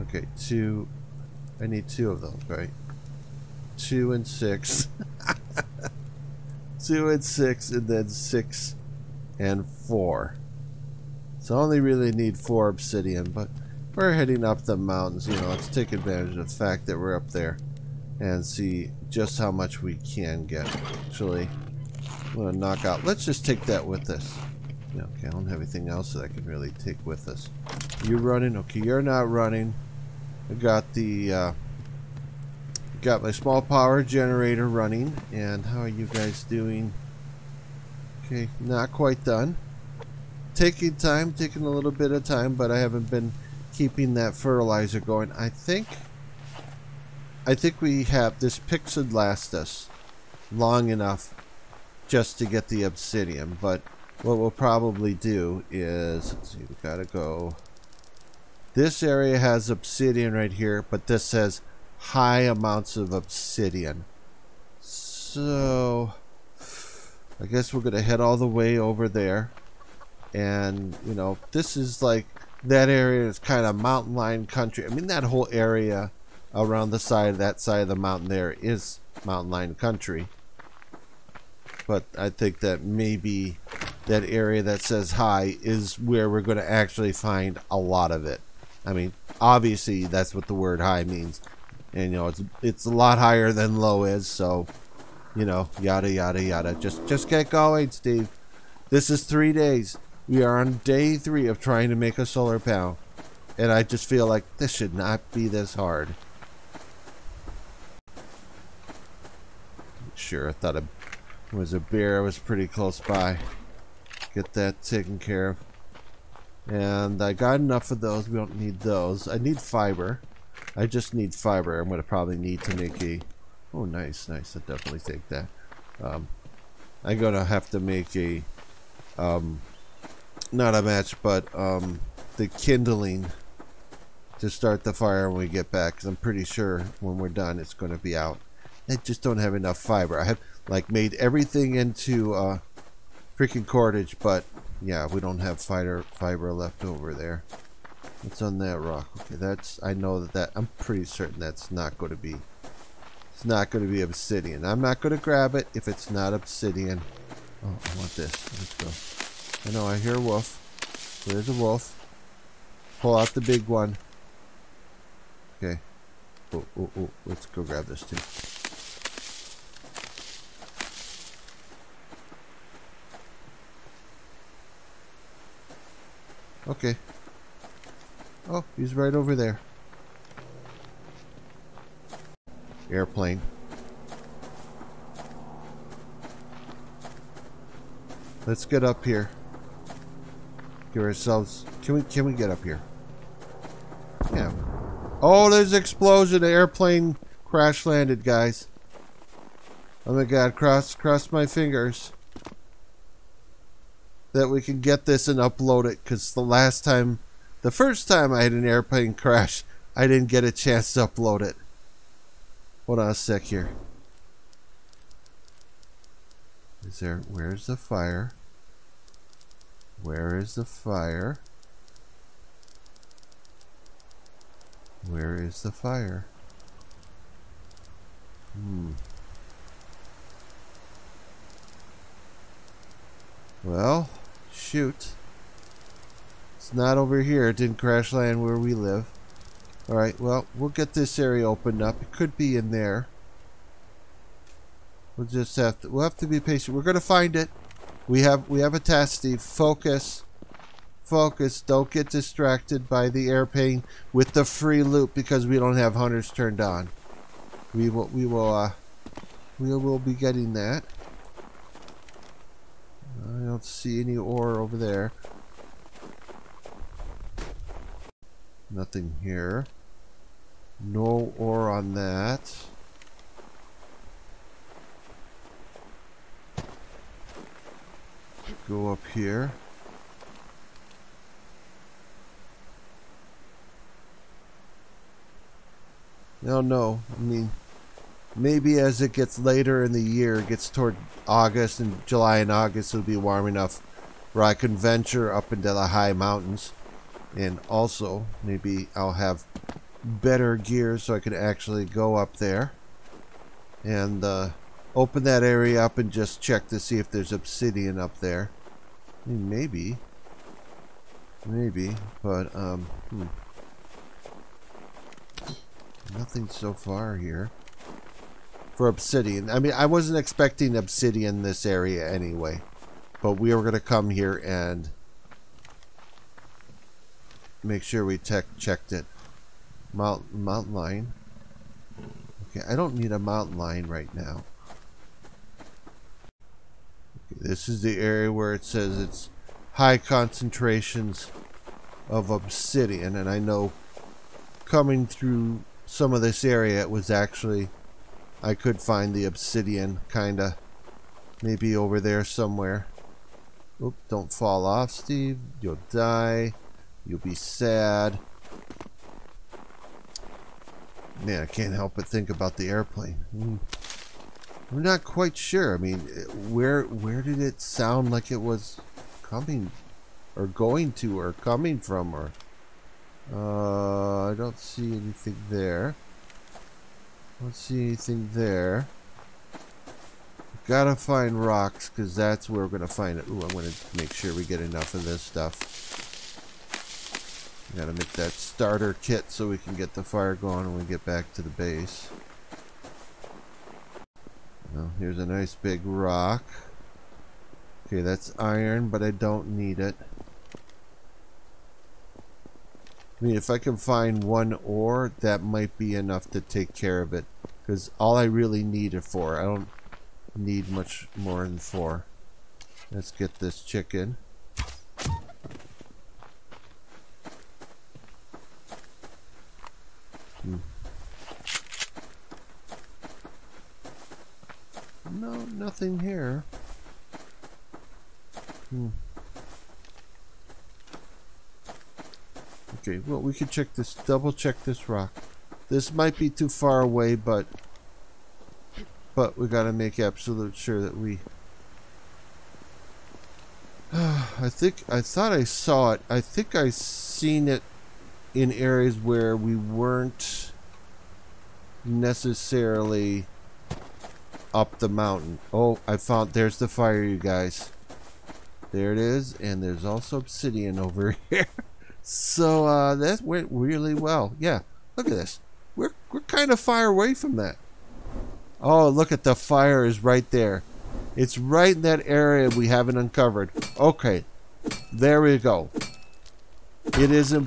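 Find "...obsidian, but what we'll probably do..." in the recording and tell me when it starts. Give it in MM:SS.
00:52.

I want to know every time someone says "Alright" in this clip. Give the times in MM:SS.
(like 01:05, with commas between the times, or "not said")
03:59.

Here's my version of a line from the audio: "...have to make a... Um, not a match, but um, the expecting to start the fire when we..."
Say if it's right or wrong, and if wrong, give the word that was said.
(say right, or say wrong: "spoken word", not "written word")
wrong: "kindling", not "expecting".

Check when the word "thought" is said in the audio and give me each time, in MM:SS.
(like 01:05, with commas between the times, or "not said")
01:50, 07:25.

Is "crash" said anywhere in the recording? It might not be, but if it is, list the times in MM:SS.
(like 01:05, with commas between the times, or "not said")
03:17, 03:29, 03:57.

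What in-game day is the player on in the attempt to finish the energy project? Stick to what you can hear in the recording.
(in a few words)
Day three.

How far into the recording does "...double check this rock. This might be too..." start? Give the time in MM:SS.
07:13.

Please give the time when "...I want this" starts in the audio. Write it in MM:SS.
02:37.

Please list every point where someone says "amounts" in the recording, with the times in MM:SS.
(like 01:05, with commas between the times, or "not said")
01:02.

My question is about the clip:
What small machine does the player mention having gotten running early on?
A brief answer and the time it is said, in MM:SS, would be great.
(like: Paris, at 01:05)
Small power generator, at 00:33.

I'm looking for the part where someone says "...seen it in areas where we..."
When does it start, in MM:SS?
07:26.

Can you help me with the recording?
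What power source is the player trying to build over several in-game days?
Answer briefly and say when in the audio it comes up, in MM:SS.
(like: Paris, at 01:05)
Solar panel, at 01:42.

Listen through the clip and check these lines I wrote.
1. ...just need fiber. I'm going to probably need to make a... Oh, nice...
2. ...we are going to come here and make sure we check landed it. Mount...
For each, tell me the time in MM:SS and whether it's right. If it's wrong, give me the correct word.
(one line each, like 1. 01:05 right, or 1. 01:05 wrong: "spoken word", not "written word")
1. 02:00 right
2. 05:23 wrong: "checked", not "landed".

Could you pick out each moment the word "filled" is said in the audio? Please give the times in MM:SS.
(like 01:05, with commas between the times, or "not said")
not said.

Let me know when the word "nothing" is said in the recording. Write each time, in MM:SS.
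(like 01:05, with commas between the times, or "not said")
04:28, 05:16, 07:05.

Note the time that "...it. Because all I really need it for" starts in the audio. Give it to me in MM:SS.
06:47.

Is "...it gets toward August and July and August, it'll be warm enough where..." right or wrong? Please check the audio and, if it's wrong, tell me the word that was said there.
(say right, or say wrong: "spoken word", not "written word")
right.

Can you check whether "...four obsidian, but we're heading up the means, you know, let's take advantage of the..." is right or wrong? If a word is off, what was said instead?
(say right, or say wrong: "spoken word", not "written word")
wrong: "mountains", not "means".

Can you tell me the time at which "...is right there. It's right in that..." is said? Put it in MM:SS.
07:49.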